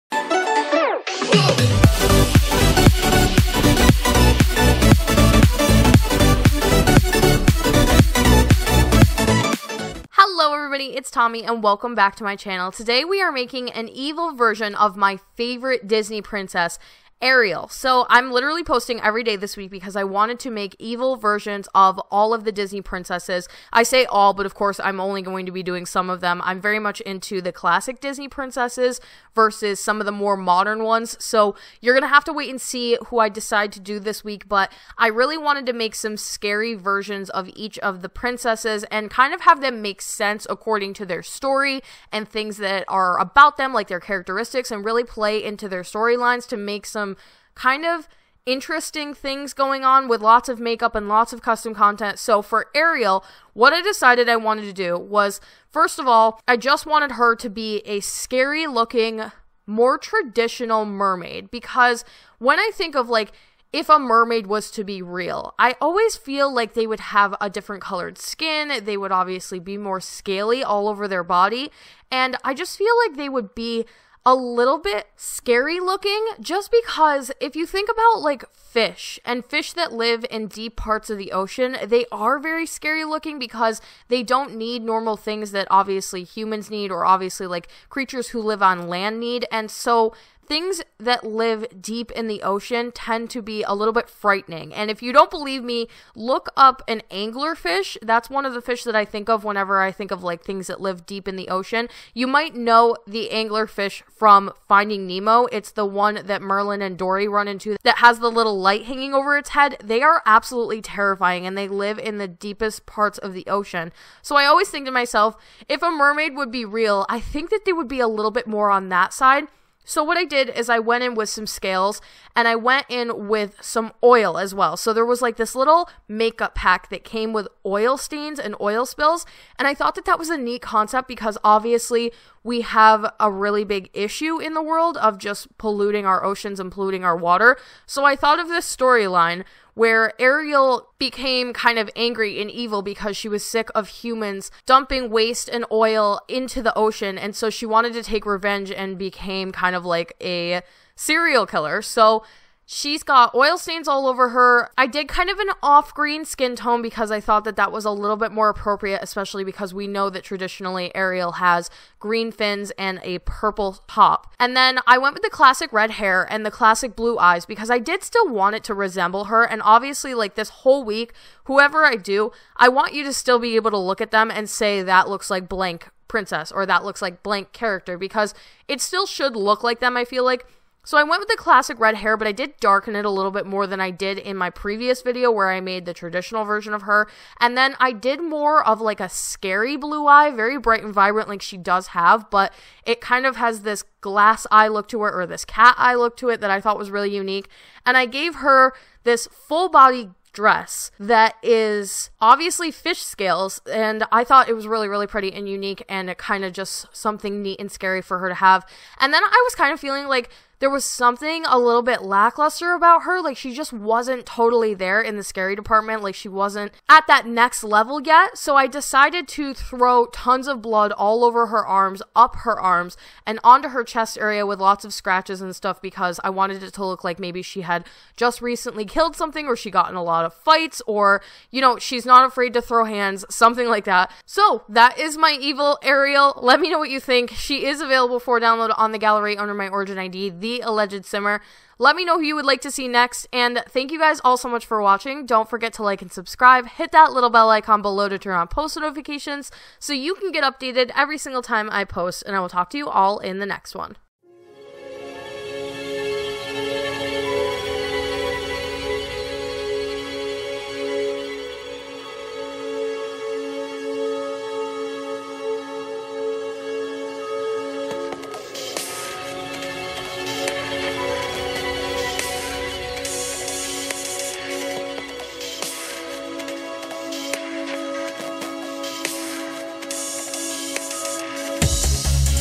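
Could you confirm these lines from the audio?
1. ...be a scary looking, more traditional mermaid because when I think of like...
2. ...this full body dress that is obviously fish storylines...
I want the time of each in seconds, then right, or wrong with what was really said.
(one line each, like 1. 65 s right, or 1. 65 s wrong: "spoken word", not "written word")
1. 57 s right
2. 199 s wrong: "scales", not "storylines".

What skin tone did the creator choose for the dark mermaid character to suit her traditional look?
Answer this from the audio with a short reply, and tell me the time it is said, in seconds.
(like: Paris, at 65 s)
Off green, at 155 s.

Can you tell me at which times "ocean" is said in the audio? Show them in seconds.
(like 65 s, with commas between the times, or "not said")
81 s, 92 s, 101 s, 113 s, 136 s, 146 s.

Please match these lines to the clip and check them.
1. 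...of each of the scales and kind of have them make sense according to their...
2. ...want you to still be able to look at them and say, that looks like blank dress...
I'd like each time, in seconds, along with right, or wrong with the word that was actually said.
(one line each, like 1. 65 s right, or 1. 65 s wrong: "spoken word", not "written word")
1. 37 s wrong: "princesses", not "scales"
2. 172 s wrong: "princess", not "dress".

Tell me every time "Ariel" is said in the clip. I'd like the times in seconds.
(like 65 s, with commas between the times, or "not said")
17 s, 52 s, 140 s, 160 s, 235 s.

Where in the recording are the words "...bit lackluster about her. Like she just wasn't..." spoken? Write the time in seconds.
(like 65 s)
211 s.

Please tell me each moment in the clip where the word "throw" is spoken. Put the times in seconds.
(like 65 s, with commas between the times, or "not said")
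219 s, 232 s.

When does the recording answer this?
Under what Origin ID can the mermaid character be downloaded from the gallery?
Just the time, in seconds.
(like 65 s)
240 s.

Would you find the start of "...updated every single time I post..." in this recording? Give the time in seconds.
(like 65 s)
250 s.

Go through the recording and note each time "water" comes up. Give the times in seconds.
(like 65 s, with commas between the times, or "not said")
137 s.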